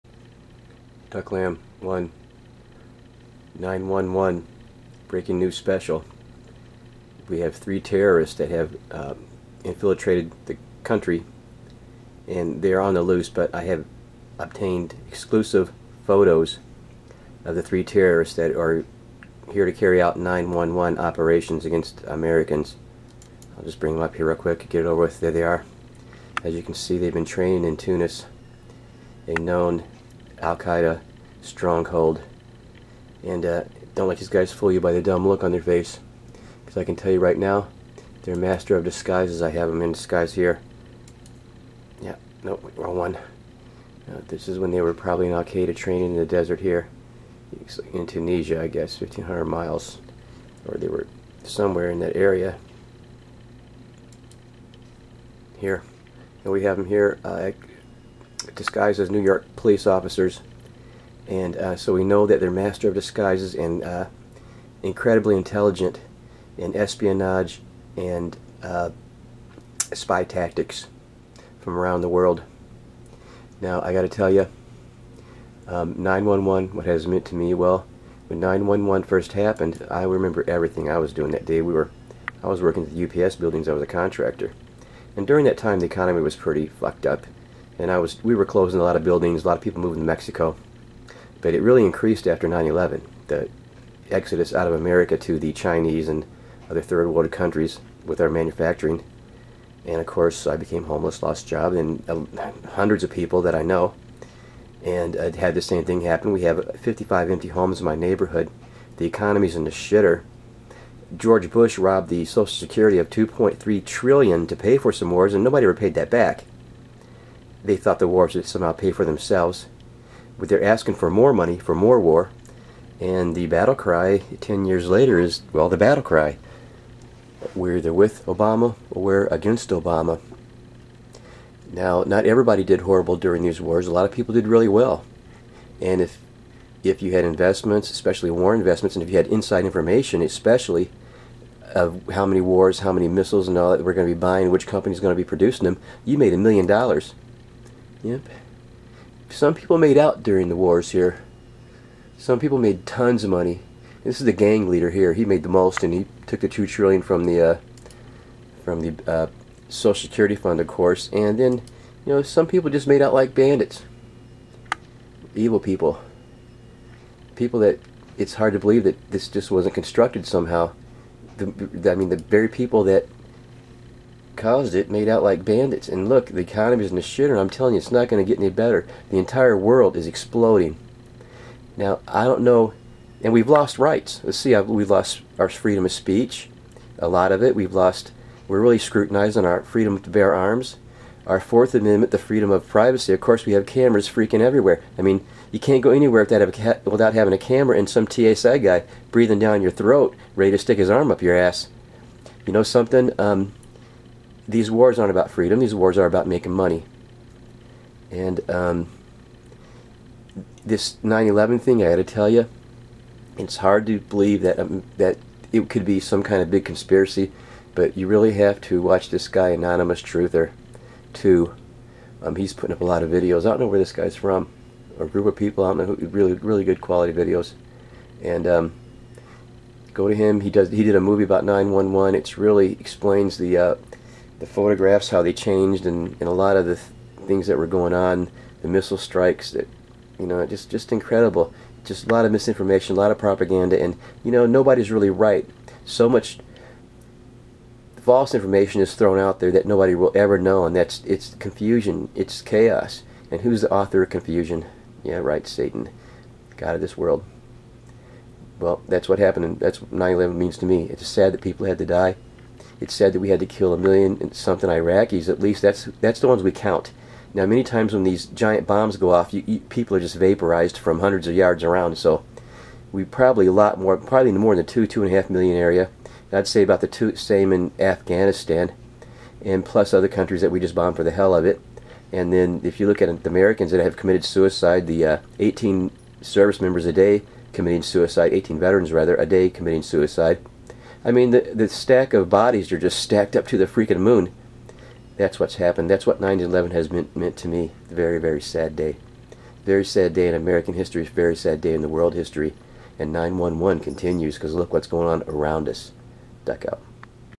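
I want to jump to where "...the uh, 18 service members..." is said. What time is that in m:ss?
4:44.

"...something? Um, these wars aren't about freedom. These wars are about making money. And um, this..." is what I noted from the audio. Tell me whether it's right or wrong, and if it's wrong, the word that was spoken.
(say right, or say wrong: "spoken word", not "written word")
right.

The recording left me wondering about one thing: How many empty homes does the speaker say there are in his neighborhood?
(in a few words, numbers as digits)
55.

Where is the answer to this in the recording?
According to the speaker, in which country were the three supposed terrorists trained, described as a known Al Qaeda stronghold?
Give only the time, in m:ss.
0:27.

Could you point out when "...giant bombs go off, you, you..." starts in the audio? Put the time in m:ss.
4:28.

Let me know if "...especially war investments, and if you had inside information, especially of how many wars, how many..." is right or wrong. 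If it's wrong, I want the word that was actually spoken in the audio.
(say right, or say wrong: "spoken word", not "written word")
right.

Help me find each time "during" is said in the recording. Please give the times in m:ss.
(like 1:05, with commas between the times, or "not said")
1:25, 2:13, 2:30.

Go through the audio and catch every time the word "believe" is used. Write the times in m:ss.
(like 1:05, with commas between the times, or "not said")
2:48, 3:33.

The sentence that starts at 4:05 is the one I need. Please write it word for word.
So much false information is thrown out there that nobody will ever know, and that's it's confusion, it's chaos.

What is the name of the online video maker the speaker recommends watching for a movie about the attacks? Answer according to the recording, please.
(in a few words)
Anonymous Truther.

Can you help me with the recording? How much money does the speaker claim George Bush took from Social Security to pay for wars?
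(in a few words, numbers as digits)
2.3 trillion.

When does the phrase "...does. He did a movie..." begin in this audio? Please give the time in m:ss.
3:50.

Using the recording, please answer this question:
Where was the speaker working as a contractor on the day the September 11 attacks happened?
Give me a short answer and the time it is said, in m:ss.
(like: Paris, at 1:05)
UPS buildings, at 1:23.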